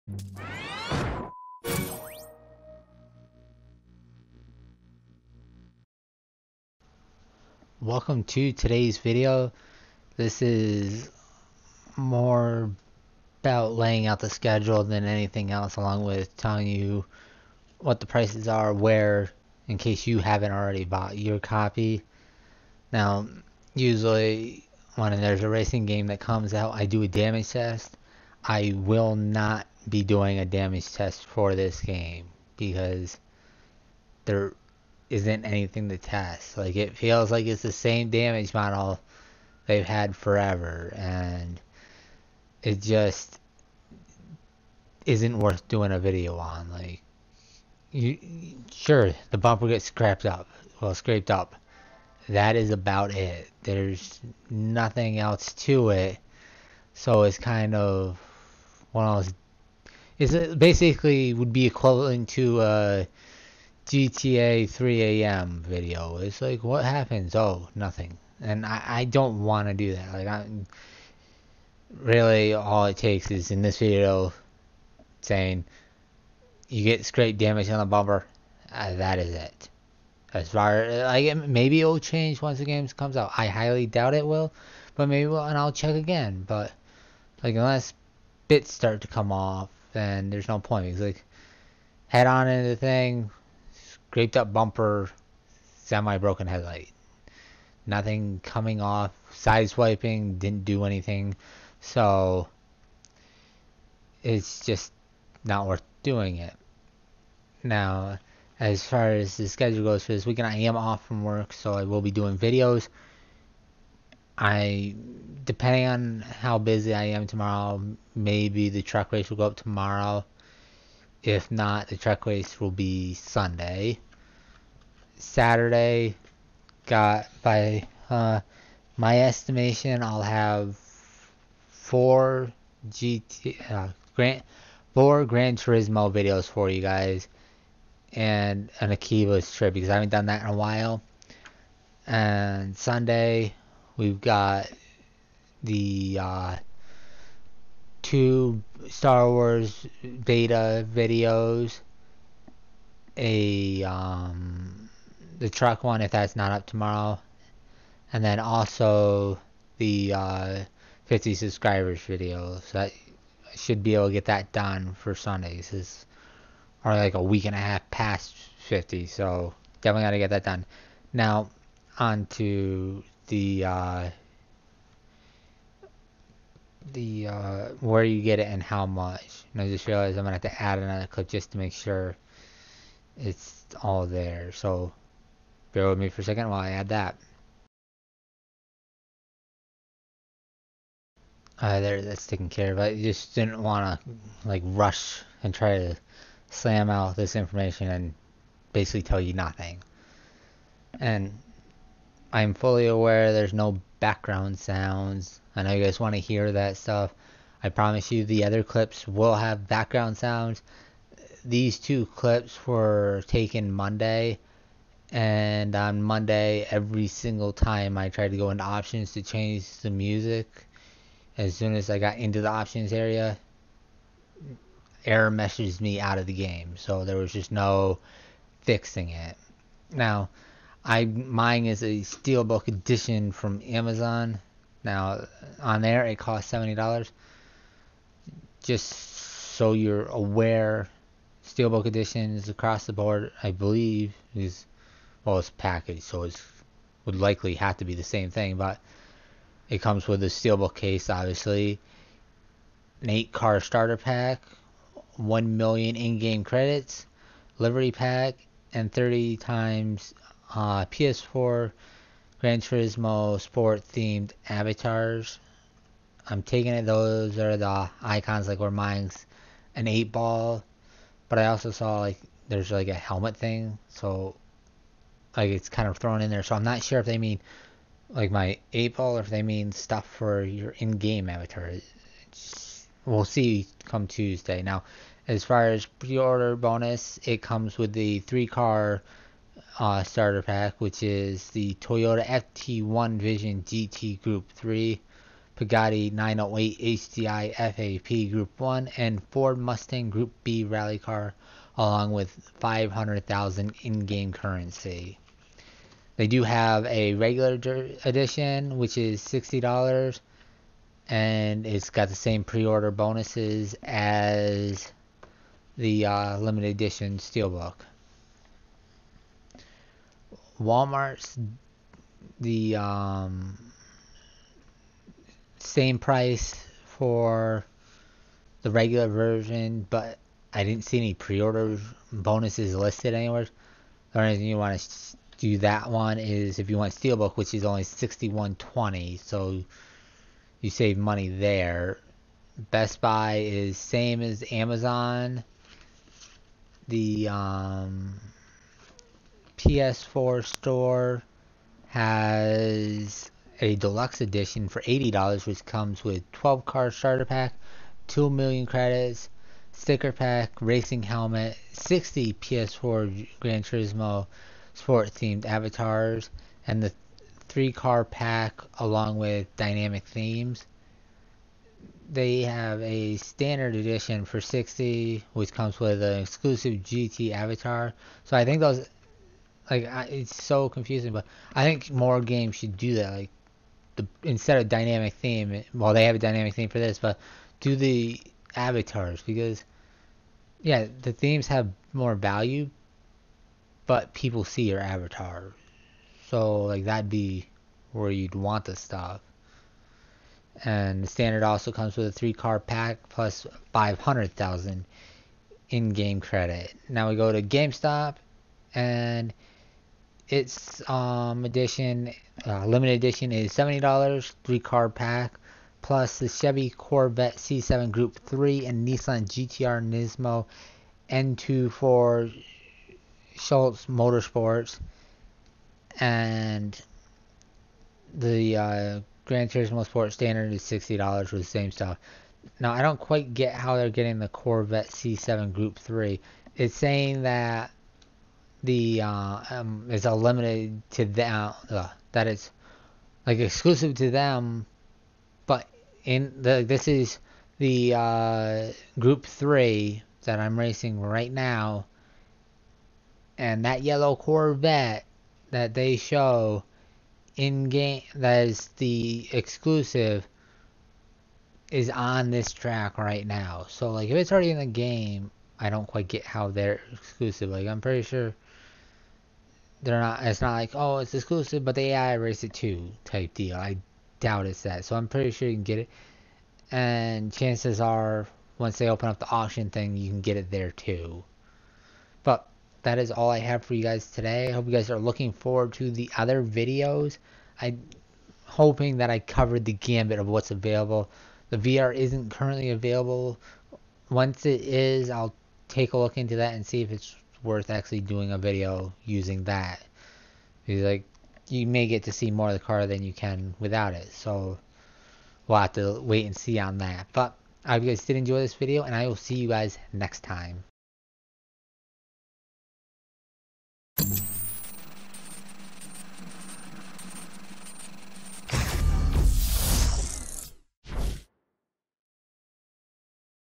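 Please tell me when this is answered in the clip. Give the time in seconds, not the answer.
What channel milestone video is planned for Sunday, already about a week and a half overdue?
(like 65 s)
161 s.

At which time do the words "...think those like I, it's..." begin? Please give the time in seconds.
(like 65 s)
378 s.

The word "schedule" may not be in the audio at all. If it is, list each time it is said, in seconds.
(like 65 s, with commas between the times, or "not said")
14 s, 109 s.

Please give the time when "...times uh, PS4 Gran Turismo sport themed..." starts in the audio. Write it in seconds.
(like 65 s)
259 s.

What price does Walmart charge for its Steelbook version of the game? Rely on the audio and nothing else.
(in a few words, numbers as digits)
$61.20.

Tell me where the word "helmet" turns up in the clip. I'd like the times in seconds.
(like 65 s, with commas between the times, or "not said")
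272 s, 361 s.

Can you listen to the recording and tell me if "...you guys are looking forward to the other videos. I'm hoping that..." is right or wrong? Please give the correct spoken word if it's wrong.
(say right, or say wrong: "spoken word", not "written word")
right.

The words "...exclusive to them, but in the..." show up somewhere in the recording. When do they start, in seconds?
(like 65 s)
443 s.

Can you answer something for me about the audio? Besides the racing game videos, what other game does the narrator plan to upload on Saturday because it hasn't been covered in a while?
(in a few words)
Akiba's Trip.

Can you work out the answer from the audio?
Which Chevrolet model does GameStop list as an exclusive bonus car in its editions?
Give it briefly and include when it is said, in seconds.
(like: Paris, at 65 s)
Corvette C7 Group 3, at 416 s.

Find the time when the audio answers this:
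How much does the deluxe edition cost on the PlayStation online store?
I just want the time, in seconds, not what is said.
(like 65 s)
354 s.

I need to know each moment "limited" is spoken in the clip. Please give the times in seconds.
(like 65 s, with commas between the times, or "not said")
316 s, 412 s, 440 s.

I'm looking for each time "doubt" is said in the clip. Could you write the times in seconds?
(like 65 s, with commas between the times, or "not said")
83 s, 474 s.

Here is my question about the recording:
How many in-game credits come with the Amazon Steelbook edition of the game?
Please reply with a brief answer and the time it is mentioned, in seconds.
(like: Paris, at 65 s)
1 million, at 255 s.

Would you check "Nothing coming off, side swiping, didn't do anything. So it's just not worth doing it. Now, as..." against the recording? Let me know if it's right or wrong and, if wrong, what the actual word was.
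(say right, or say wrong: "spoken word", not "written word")
right.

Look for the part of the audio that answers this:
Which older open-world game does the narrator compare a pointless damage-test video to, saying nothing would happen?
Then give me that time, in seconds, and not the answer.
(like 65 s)
63 s.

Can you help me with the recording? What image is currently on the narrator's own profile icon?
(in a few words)
an eight ball.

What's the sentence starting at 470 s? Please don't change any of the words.
It's not like oh, it's exclusive, but the AI erased it too type deal.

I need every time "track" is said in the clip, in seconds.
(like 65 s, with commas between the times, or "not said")
121 s, 462 s.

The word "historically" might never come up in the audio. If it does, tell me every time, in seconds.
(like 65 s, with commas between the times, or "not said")
not said.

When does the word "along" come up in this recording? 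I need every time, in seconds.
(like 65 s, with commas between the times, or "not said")
15 s, 301 s, 368 s.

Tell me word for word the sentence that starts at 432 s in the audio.
Now, I don't quite get how they're getting the Corvette C7 Group 3.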